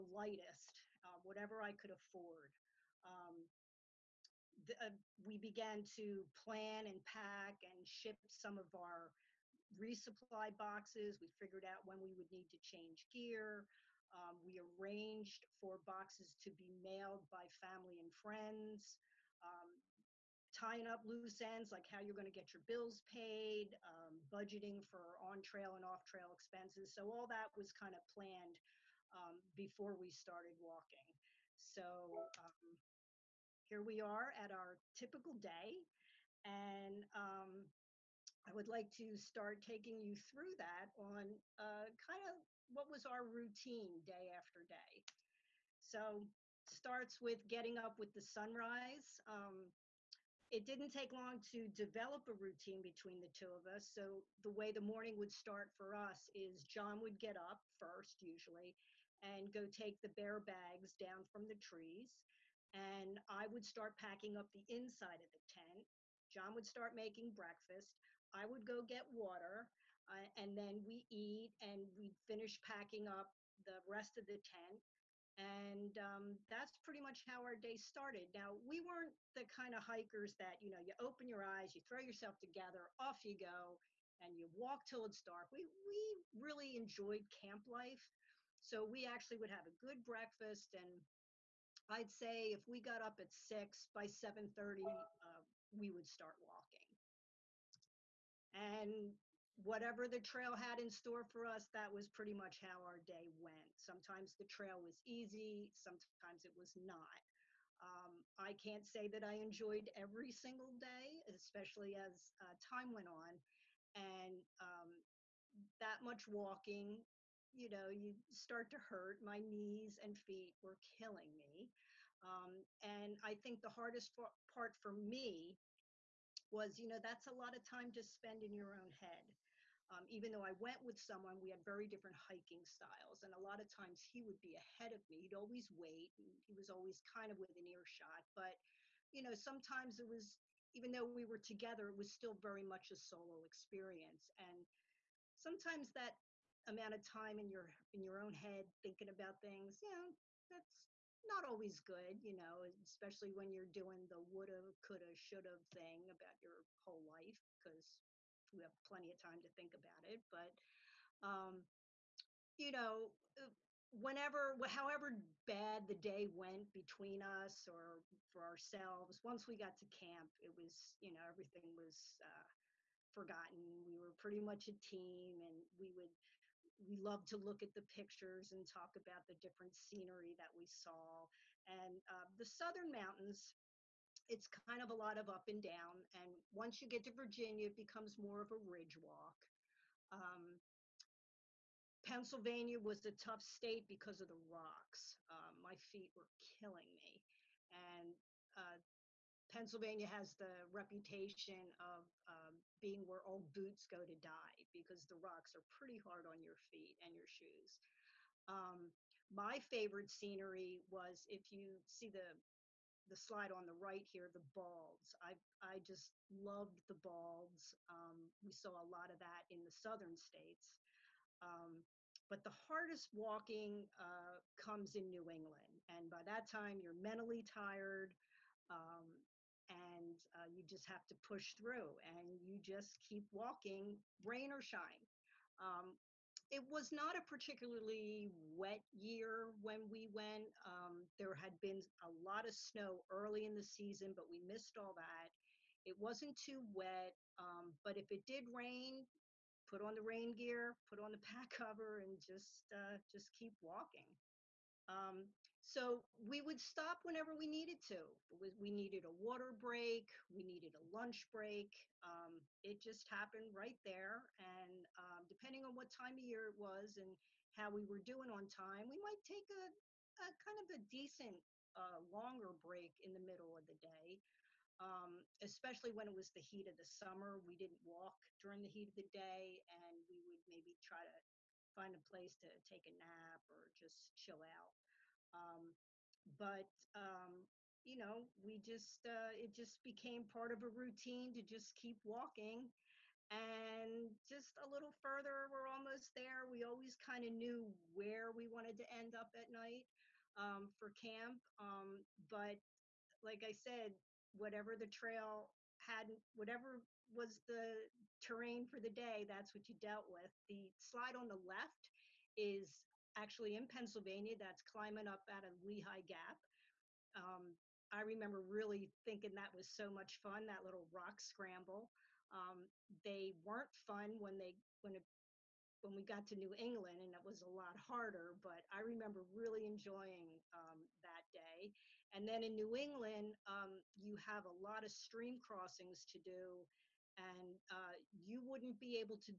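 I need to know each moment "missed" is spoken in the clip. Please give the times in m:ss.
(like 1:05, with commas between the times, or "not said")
4:04.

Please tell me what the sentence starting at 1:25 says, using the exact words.
We, we really enjoyed camp life.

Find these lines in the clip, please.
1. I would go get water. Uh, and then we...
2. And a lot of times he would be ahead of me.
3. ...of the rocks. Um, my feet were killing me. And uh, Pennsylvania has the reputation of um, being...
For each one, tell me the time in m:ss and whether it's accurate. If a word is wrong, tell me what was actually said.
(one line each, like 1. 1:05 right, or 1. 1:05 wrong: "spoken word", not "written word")
1. 1:08 right
2. 2:13 right
3. 3:14 right.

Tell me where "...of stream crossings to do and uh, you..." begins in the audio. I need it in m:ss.
5:34.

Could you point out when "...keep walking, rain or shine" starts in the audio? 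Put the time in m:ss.
3:52.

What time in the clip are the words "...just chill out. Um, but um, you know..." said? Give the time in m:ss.
4:43.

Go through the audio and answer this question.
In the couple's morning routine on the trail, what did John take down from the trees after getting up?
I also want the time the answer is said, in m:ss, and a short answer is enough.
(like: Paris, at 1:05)
Bear bags, at 1:00.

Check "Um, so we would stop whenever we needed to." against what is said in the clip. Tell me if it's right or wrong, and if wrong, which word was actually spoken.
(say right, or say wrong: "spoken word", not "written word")
right.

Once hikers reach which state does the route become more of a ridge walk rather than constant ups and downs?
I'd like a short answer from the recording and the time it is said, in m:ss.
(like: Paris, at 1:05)
Virginia, at 3:07.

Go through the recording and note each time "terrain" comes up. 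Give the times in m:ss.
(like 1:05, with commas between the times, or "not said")
5:08.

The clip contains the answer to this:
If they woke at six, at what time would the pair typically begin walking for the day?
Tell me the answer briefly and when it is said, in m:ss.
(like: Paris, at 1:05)
7:30, at 1:34.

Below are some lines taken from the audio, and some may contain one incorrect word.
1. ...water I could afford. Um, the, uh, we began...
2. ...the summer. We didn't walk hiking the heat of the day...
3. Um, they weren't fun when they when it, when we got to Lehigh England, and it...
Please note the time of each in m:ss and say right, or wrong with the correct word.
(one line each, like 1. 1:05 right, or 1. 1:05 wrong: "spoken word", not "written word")
1. 0:01 wrong: "whatever", not "water"
2. 4:36 wrong: "during", not "hiking"
3. 5:22 wrong: "New", not "Lehigh".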